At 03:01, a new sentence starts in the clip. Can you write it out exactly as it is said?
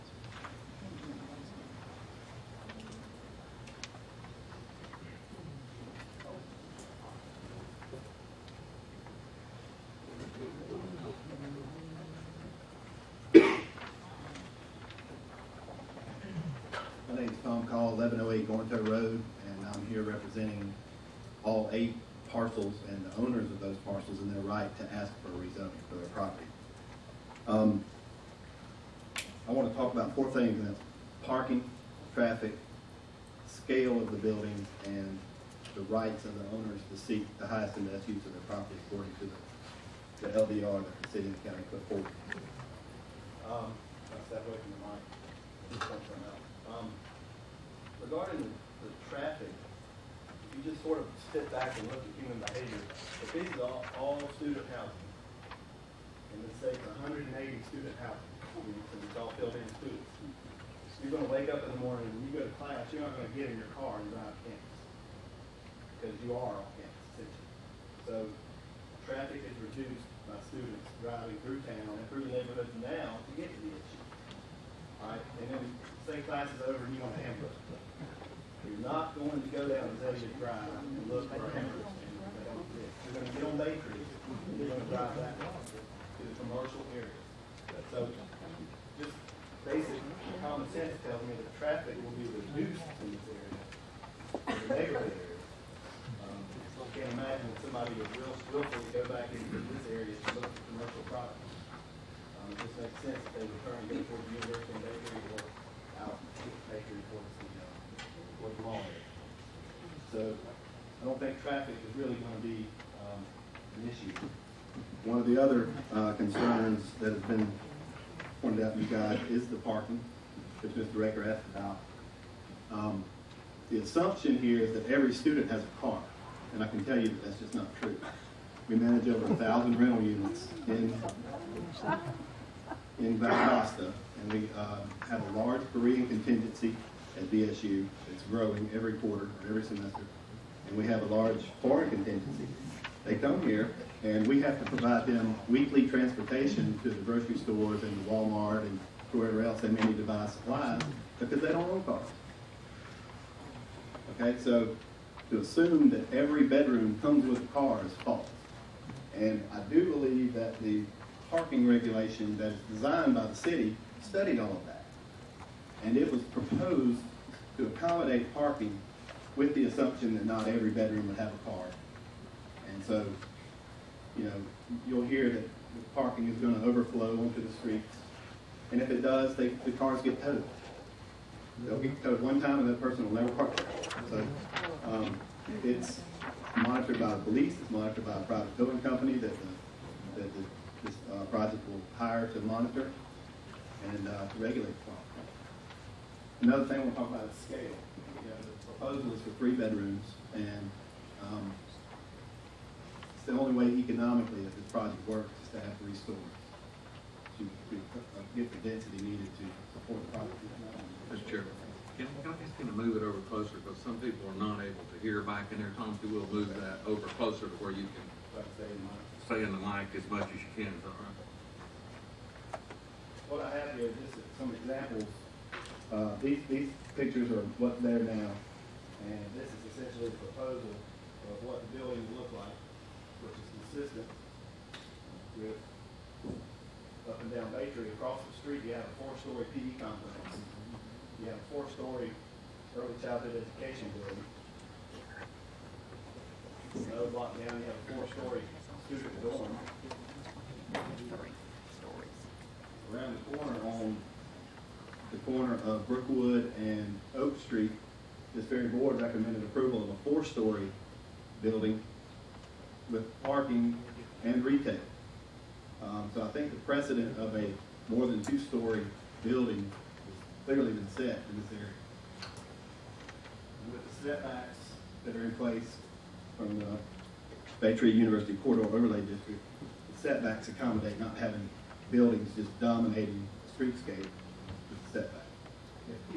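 They'll get towed one time and that person will never park there.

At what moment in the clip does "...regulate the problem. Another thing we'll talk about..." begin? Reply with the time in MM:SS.
03:14.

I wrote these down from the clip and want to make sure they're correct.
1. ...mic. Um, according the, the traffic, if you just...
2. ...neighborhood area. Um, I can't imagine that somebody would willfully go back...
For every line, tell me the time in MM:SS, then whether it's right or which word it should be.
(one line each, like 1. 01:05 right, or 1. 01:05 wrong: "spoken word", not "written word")
1. 00:45 wrong: "regarding", not "according"
2. 01:34 right.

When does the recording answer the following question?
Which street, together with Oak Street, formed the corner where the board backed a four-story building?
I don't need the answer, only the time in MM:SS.
04:15.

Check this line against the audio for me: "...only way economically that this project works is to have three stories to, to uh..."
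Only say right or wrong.
right.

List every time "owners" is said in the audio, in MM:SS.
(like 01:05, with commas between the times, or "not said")
00:23, 00:36.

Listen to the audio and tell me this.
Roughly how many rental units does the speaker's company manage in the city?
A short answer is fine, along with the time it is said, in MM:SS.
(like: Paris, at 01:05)
over 1,000, at 02:09.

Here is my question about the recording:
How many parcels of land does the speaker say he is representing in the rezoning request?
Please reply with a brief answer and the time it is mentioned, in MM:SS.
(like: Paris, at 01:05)
8, at 00:21.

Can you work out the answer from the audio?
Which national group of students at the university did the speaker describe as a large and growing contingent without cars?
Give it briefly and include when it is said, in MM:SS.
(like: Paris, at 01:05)
Korean, at 02:15.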